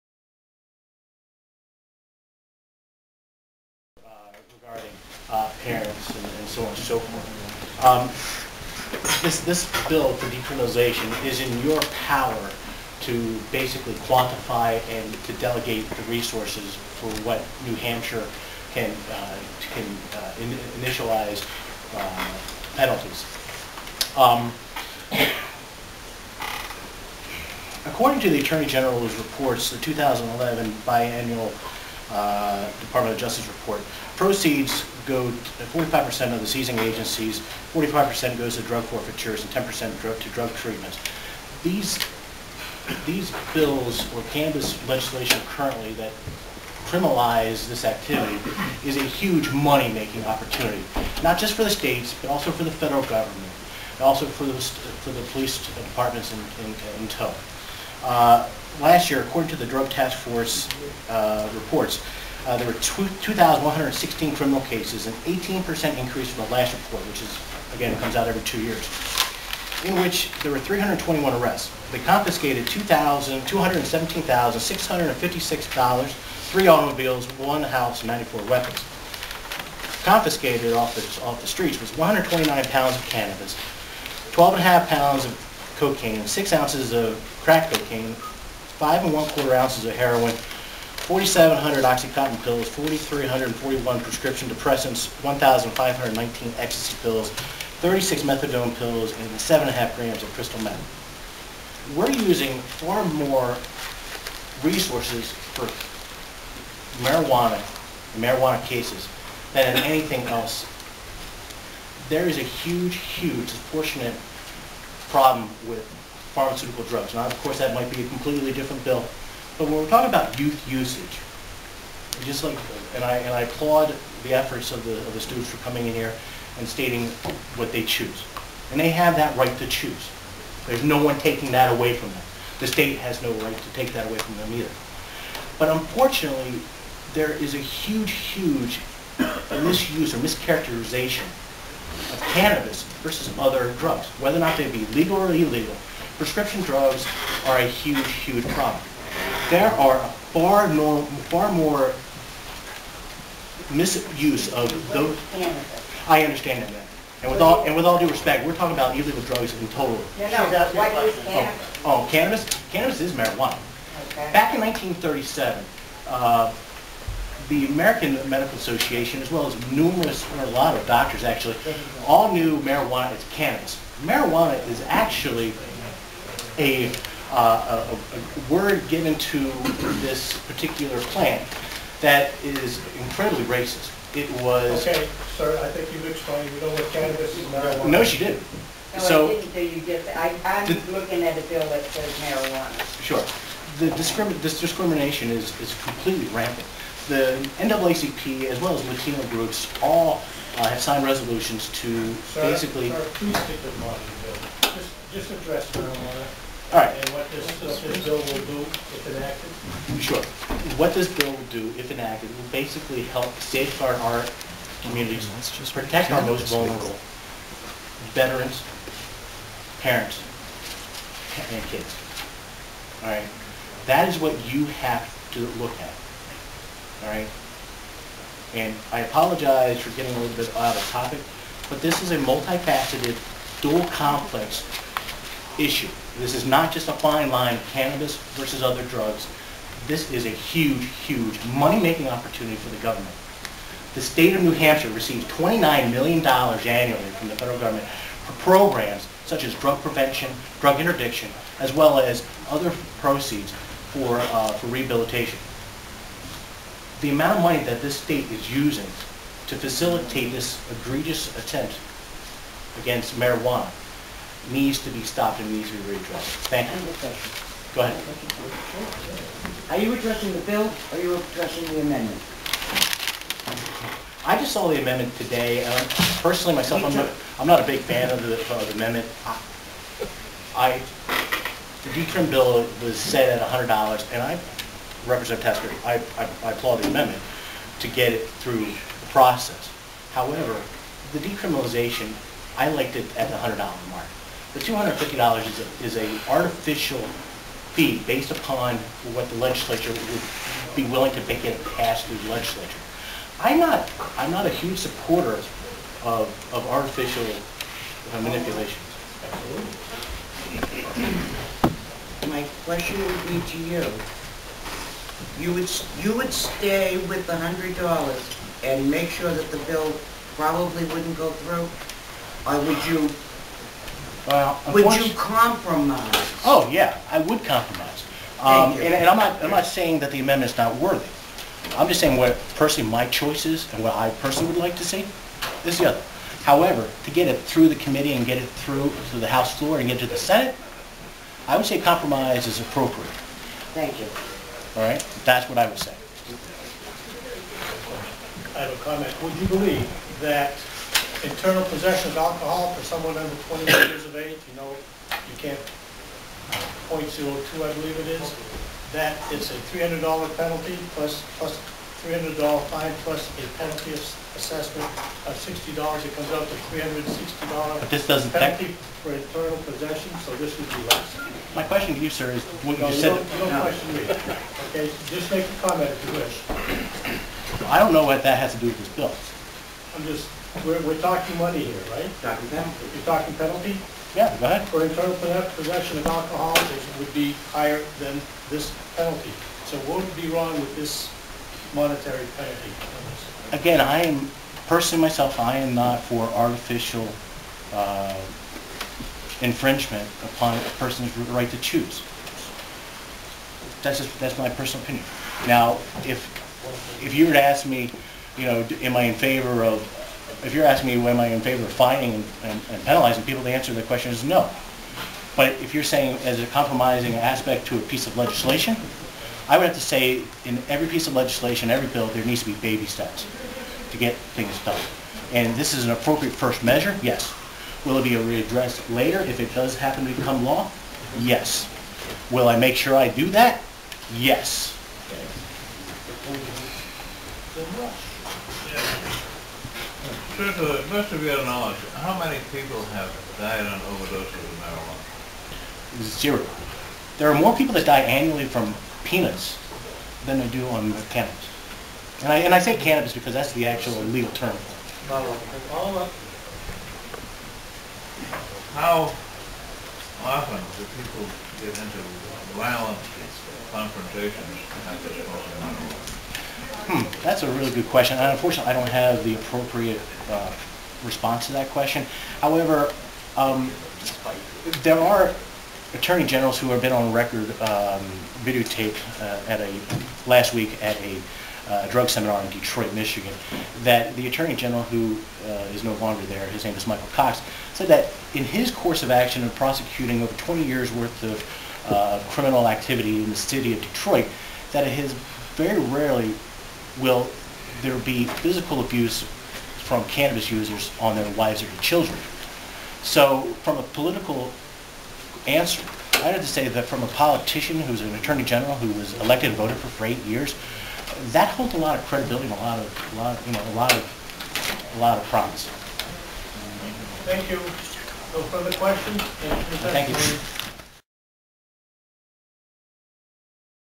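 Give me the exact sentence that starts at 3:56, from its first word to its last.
This is not just a fine line, cannabis versus other drugs.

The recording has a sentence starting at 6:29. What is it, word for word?
So what would be wrong with this monetary penalty.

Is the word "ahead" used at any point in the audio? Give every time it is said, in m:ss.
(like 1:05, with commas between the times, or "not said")
4:27, 6:24.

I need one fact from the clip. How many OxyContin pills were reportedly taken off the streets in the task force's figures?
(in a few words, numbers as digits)
4,700.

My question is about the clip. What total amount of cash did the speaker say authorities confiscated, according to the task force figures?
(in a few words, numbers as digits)
$217,656.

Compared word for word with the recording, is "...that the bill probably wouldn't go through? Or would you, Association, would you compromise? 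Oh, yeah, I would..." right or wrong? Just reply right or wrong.
wrong.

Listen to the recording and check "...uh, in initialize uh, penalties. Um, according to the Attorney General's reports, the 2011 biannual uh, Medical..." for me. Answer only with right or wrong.
wrong.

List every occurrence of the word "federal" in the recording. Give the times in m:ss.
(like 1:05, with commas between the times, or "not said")
0:52, 4:07.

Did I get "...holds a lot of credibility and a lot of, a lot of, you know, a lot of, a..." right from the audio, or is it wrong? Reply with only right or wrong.
right.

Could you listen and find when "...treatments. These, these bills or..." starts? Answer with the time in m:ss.
0:40.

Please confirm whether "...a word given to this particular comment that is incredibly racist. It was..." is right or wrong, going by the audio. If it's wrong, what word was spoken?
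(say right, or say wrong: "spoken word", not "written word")
wrong: "plant", not "comment".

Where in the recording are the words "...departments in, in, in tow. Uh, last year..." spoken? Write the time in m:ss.
0:55.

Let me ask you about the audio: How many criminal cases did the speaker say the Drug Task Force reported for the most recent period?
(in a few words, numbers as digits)
2,116.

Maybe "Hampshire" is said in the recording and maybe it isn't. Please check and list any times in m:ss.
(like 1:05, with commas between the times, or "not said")
0:17, 4:04.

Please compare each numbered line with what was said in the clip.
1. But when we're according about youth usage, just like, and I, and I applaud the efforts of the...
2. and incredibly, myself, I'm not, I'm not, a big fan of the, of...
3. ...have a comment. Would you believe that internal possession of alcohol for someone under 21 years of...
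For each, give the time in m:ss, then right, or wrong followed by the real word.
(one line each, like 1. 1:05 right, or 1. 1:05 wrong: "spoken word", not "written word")
1. 1:59 wrong: "talking", not "according"
2. 4:35 wrong: "personally", not "incredibly"
3. 5:48 right.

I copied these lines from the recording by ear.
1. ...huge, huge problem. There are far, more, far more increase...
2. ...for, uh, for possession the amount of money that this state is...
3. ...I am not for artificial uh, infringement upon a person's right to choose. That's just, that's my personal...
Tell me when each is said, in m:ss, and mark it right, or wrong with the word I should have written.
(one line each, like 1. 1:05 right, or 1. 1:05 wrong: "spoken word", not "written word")
1. 2:27 wrong: "misuse", not "increase"
2. 4:13 wrong: "rehabilitation", not "possession"
3. 6:35 right.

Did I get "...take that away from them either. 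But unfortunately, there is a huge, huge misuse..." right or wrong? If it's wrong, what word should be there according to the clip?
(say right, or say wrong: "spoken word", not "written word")
right.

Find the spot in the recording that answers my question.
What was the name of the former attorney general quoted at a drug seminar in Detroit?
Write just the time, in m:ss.
8:06.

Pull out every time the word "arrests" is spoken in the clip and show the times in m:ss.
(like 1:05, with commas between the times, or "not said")
1:11.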